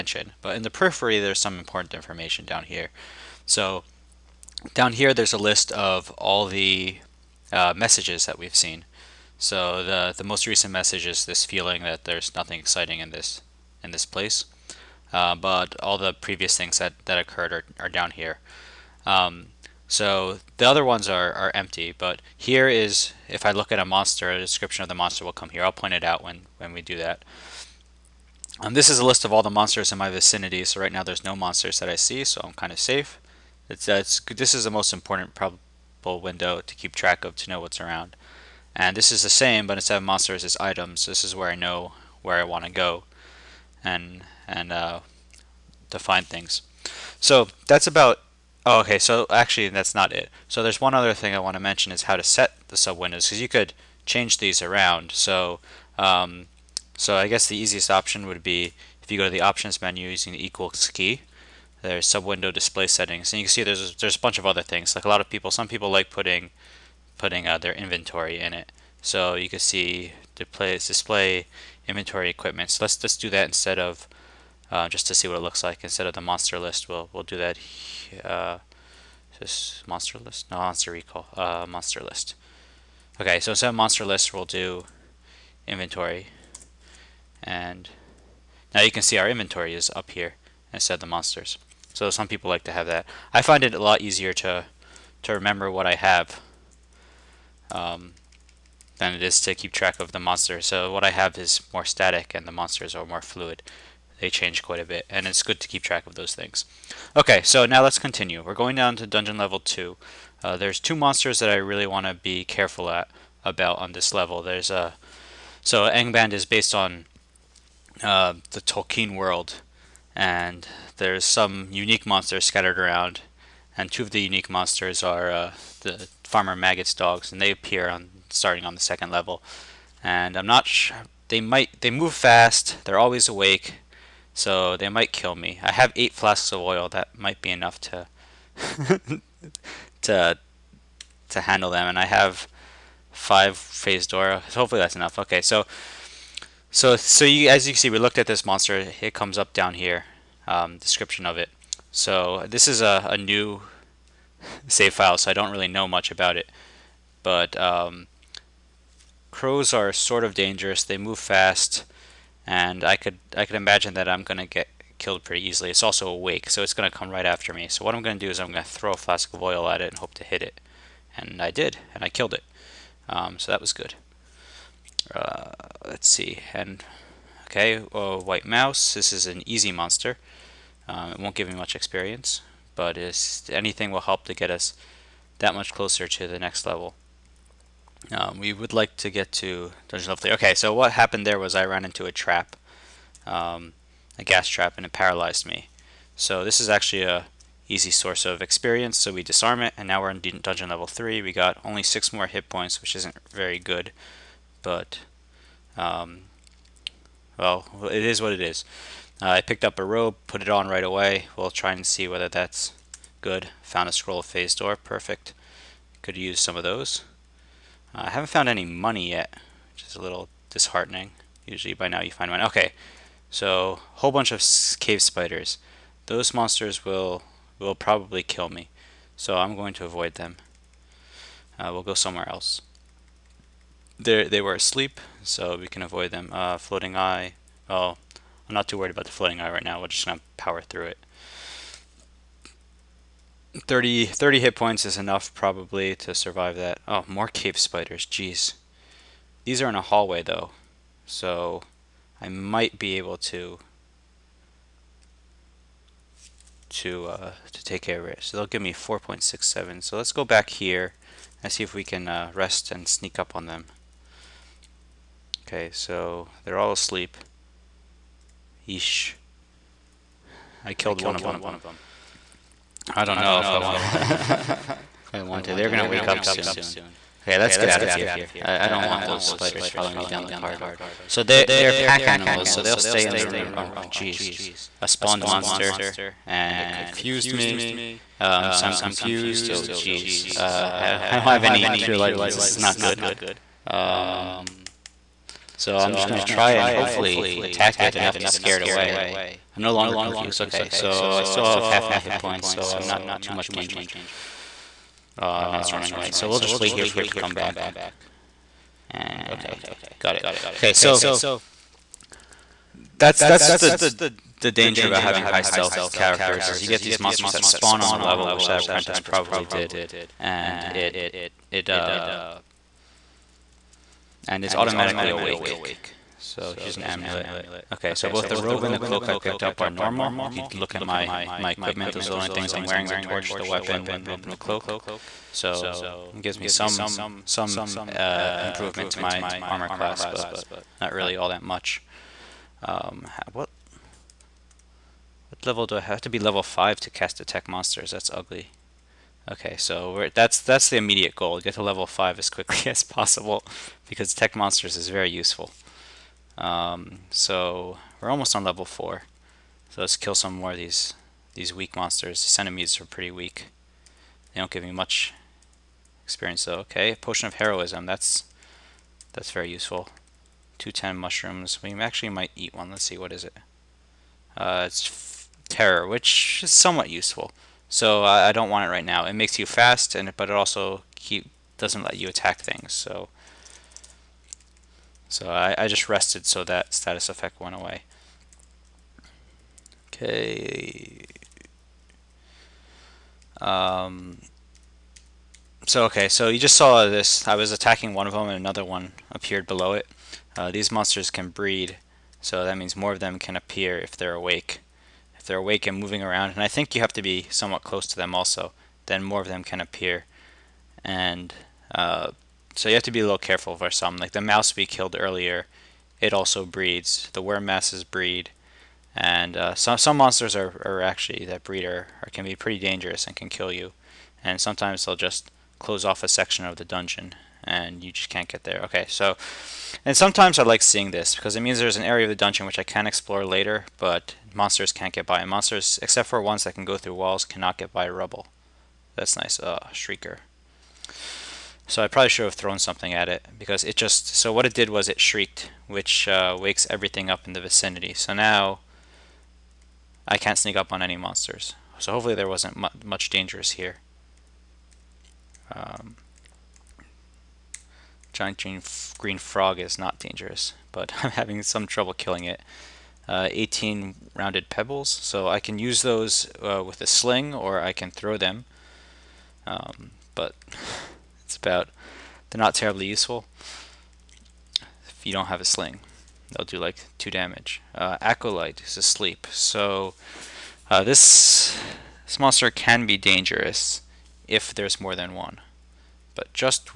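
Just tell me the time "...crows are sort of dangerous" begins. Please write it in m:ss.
2:39.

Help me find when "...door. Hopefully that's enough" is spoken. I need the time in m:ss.
2:24.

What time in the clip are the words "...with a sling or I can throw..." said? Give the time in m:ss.
7:46.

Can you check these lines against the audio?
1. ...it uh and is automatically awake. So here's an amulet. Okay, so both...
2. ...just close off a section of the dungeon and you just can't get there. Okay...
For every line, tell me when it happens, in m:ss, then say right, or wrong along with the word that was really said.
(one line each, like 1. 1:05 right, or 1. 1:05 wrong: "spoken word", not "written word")
1. 5:21 right
2. 7:04 right.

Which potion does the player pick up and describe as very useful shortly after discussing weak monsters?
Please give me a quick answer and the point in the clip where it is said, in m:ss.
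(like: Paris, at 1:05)
Potion of Heroism, at 6:06.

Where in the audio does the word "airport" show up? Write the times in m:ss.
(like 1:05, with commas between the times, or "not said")
not said.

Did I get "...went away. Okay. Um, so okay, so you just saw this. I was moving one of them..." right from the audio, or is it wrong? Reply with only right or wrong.
wrong.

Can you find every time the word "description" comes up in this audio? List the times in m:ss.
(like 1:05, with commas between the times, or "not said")
0:24, 2:30.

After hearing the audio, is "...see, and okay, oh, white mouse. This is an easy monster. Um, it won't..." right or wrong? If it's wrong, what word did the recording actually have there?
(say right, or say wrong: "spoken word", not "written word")
right.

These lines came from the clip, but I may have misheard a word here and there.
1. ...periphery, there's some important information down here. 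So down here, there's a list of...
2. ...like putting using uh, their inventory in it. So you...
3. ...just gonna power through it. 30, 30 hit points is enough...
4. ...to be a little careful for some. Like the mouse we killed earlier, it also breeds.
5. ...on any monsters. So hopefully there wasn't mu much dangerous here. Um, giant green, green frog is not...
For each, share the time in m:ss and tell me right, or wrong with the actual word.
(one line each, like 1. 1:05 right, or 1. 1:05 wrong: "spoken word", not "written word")
1. 0:00 right
2. 1:05 wrong: "putting", not "using"
3. 3:59 right
4. 6:52 right
5. 7:30 right.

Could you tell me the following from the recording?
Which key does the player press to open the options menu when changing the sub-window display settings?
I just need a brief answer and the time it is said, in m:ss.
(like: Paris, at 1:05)
Equals key, at 1:00.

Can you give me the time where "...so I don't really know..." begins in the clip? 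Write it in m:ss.
2:35.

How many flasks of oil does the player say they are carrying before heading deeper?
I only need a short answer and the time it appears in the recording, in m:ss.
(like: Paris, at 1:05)
8, at 2:15.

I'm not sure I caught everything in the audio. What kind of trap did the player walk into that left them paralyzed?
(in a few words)
Gas trap.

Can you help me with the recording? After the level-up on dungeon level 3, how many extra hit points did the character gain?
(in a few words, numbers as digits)
6.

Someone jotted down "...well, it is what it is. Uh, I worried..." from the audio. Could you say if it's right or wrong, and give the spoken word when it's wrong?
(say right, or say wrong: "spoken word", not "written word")
wrong: "picked", not "worried".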